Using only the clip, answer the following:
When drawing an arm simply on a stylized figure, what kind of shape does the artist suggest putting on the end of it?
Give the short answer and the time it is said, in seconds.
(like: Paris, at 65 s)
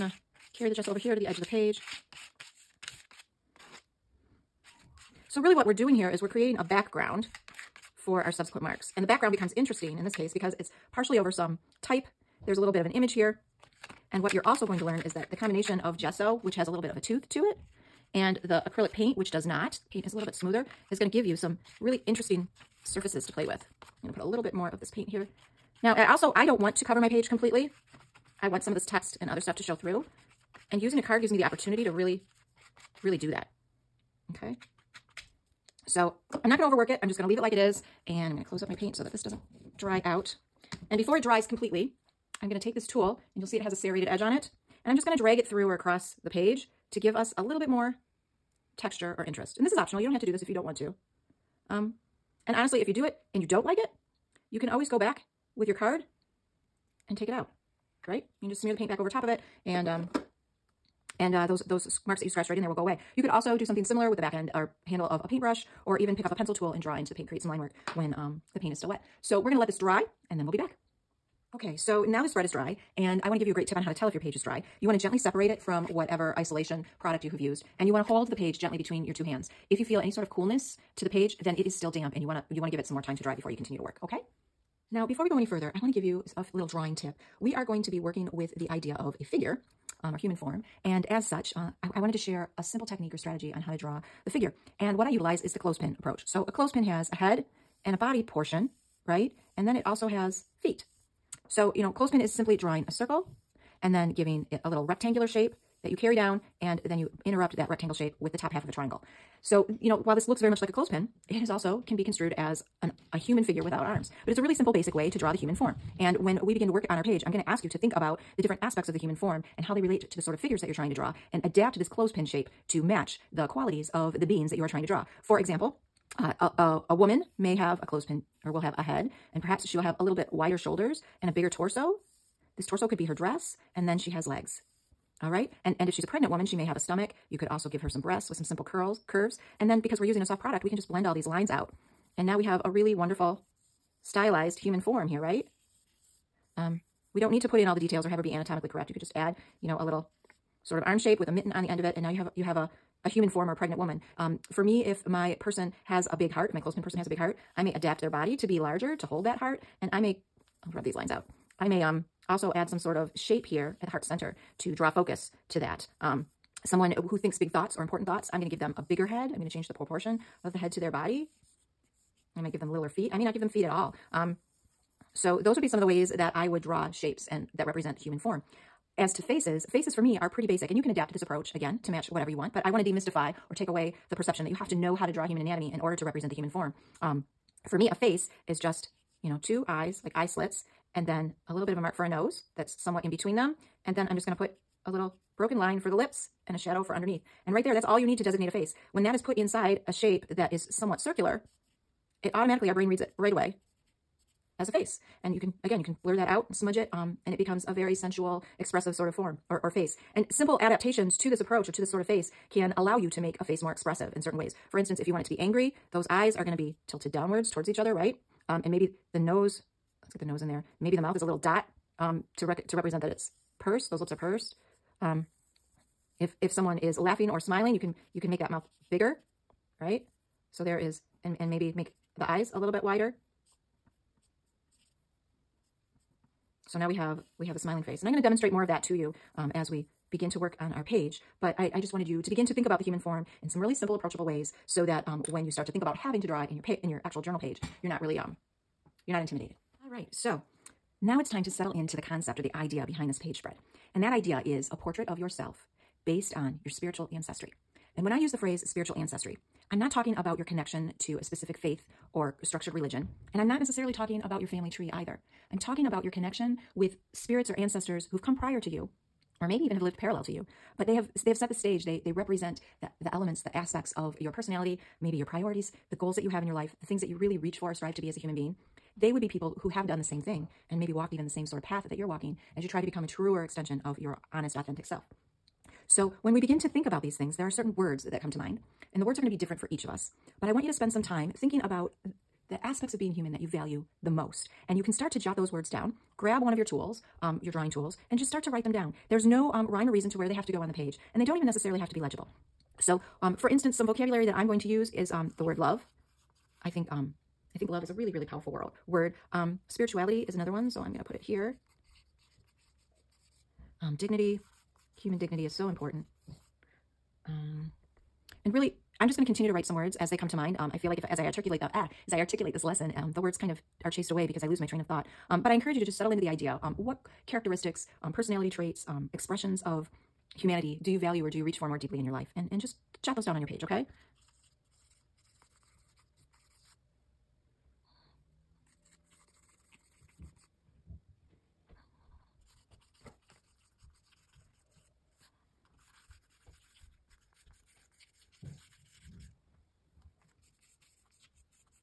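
a mitten, at 151 s.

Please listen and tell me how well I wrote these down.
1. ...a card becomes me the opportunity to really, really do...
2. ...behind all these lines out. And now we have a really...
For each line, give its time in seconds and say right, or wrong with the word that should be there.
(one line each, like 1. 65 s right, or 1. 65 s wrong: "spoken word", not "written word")
1. 30 s wrong: "gives", not "becomes"
2. 140 s wrong: "blend", not "behind".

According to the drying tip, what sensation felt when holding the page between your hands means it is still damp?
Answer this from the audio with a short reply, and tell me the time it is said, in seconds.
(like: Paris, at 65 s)
coolness, at 80 s.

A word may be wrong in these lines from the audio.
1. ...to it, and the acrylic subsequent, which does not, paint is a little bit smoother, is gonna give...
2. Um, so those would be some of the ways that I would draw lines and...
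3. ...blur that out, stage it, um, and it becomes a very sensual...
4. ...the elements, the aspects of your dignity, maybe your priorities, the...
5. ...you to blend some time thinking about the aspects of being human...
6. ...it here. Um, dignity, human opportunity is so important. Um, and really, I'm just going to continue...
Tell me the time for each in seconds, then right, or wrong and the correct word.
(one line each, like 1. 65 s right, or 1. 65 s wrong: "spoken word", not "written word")
1. 17 s wrong: "paint", not "subsequent"
2. 174 s wrong: "shapes", not "lines"
3. 206 s wrong: "smudge", not "stage"
4. 273 s wrong: "personality", not "dignity"
5. 290 s wrong: "spend", not "blend"
6. 311 s wrong: "dignity", not "opportunity".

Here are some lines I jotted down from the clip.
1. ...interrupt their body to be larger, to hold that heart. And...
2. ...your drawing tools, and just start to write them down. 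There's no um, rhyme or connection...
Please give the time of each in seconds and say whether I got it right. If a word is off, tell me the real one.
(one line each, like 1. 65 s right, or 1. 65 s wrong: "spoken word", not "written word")
1. 157 s wrong: "adapt", not "interrupt"
2. 297 s wrong: "reason", not "connection".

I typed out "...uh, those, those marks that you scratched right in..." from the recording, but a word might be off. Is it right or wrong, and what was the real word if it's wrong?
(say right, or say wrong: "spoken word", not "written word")
right.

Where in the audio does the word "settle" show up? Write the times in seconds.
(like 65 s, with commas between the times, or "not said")
251 s, 325 s.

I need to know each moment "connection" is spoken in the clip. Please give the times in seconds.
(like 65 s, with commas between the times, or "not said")
260 s, 266 s.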